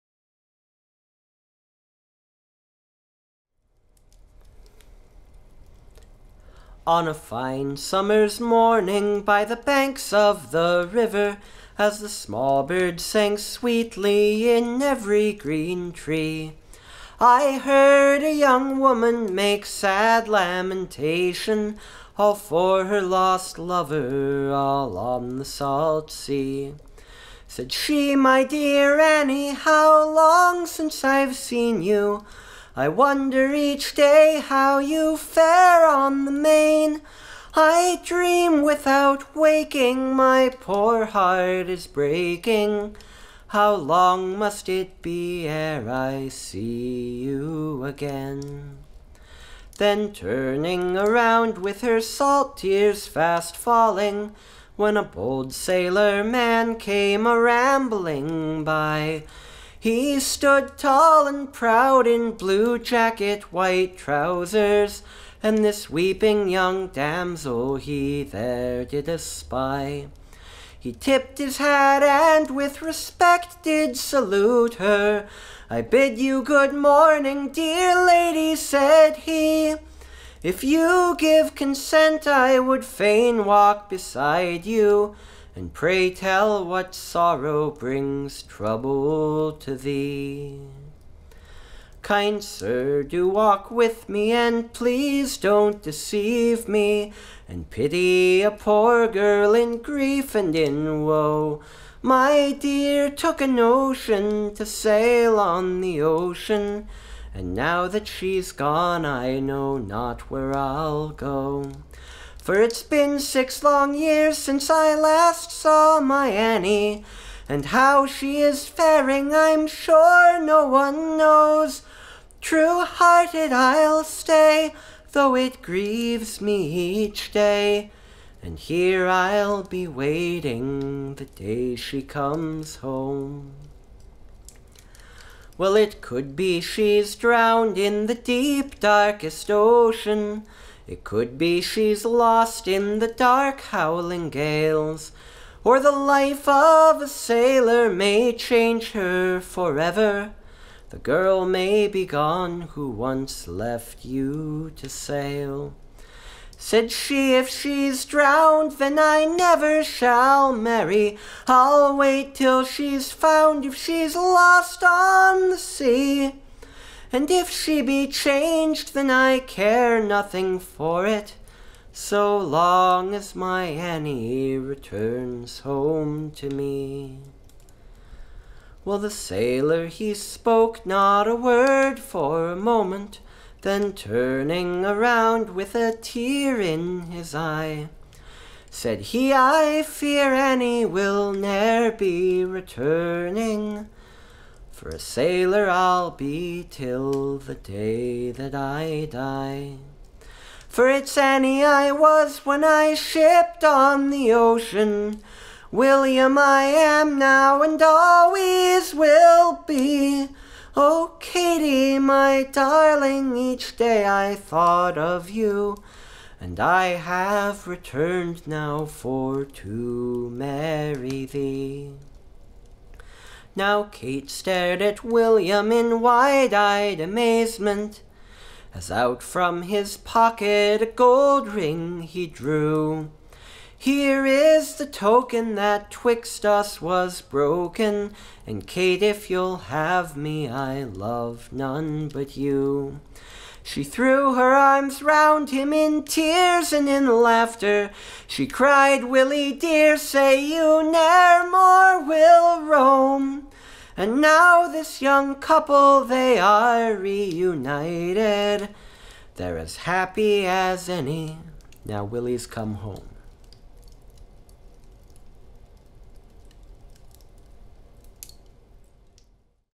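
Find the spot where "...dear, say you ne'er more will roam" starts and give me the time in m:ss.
4:09.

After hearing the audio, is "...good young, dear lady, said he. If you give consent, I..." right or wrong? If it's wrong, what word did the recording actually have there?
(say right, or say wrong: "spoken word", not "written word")
wrong: "morning", not "young".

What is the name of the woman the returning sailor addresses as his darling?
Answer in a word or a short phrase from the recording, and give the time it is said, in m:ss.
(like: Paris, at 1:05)
Katy, at 3:31.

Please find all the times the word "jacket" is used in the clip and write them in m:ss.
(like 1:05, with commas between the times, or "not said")
1:02.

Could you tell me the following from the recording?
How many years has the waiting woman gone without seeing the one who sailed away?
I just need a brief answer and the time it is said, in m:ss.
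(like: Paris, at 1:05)
6, at 1:53.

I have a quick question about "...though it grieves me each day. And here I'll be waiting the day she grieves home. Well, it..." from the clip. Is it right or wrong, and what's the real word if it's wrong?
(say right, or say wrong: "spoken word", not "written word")
wrong: "comes", not "grieves".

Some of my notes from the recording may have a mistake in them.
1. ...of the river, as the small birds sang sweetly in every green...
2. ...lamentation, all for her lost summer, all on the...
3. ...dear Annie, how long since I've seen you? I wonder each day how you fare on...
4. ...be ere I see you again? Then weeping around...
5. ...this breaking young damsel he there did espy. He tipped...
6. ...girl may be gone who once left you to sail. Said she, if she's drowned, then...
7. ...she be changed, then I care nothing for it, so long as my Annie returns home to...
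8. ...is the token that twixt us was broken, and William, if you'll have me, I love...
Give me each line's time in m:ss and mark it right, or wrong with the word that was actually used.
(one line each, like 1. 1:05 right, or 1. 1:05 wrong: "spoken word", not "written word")
1. 0:10 right
2. 0:20 wrong: "lover", not "summer"
3. 0:28 right
4. 0:45 wrong: "turning", not "weeping"
5. 1:05 wrong: "weeping", not "breaking"
6. 2:30 right
7. 2:47 right
8. 3:54 wrong: "Kate", not "William".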